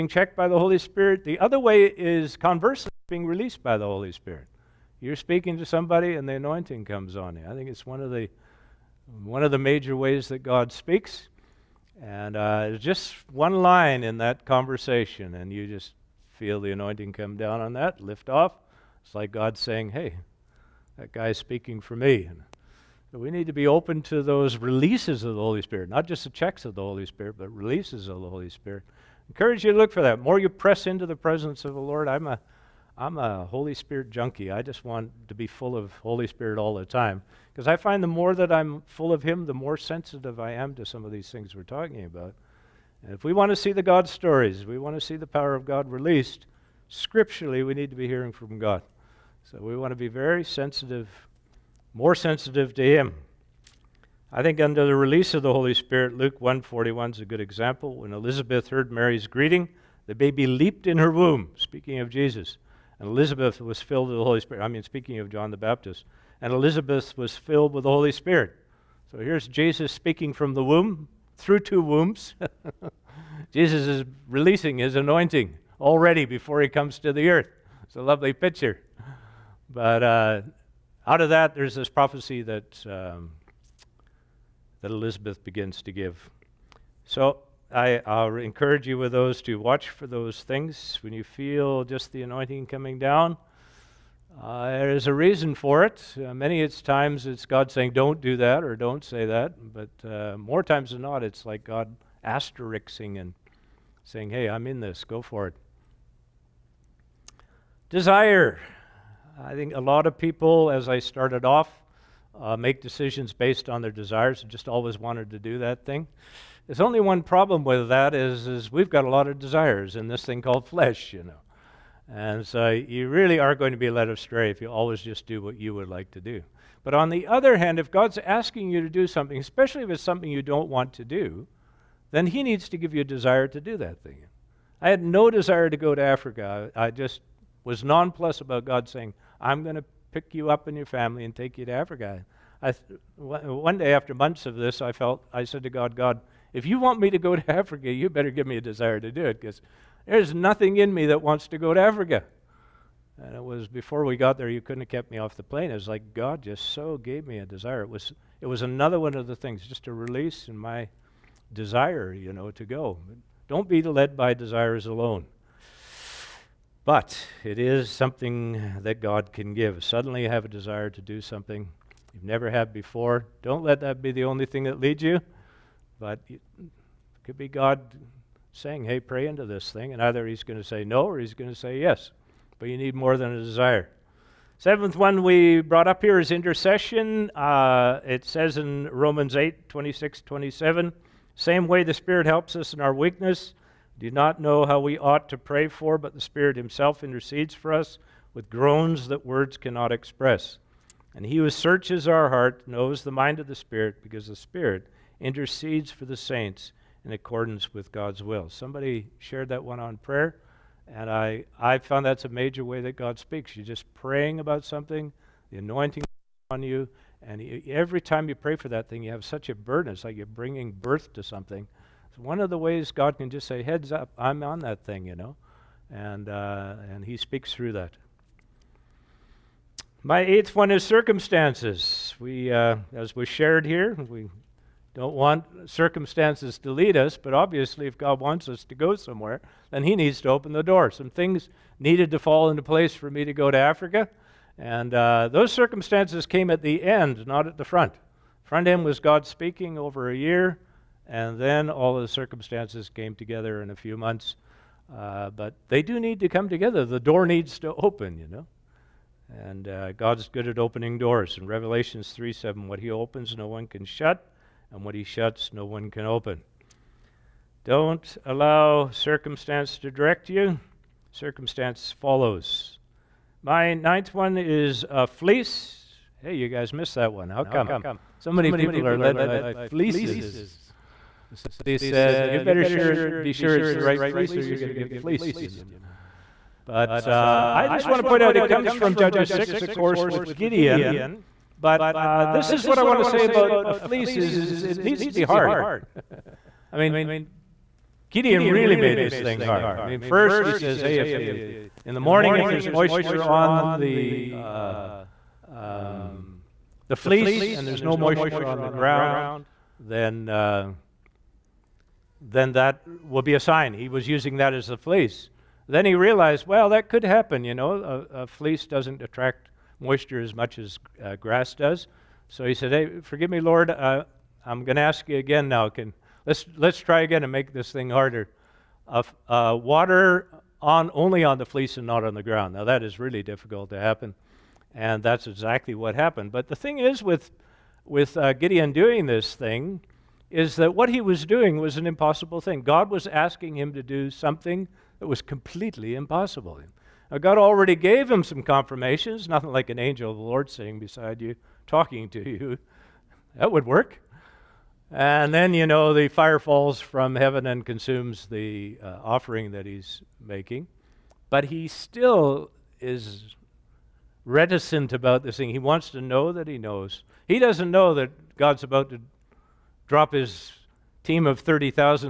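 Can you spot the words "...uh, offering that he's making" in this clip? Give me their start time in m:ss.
5:58.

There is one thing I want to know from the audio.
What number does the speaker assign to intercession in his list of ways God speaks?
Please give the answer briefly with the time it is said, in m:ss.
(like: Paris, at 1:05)
Seventh, at 3:04.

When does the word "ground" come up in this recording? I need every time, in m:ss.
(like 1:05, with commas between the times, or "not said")
5:08, 5:32.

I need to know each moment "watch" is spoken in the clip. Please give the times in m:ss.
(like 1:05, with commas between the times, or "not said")
1:29.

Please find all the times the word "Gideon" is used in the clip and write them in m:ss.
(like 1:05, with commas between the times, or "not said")
4:50, 4:58, 5:38.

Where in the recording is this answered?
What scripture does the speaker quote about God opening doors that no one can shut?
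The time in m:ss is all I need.
4:21.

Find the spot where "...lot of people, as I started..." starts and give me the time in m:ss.
1:49.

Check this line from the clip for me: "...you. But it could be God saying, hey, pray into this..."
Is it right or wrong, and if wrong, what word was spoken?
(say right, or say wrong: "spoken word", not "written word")
right.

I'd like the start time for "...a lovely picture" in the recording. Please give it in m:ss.
1:17.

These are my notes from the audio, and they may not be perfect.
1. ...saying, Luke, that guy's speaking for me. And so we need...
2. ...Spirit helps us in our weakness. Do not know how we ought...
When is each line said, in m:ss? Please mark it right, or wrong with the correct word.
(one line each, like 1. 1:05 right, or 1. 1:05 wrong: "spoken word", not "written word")
1. 0:19 wrong: "Hey", not "Luke"
2. 3:11 right.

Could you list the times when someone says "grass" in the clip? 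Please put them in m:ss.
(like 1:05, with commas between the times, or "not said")
5:21.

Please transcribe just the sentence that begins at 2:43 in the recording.
Don't be led by desires alone.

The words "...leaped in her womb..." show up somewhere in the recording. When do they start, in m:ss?
1:00.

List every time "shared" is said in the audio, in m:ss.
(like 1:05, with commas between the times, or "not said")
3:29, 3:53.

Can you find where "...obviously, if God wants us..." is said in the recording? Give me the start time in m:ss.
3:57.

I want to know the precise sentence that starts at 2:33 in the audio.
And it was before we got there, you couldn't have kept me off the plane.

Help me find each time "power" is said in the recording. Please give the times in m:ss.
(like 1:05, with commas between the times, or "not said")
0:45.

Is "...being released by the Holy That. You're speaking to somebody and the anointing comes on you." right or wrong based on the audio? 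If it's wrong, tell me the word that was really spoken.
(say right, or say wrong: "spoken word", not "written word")
wrong: "Spirit", not "That".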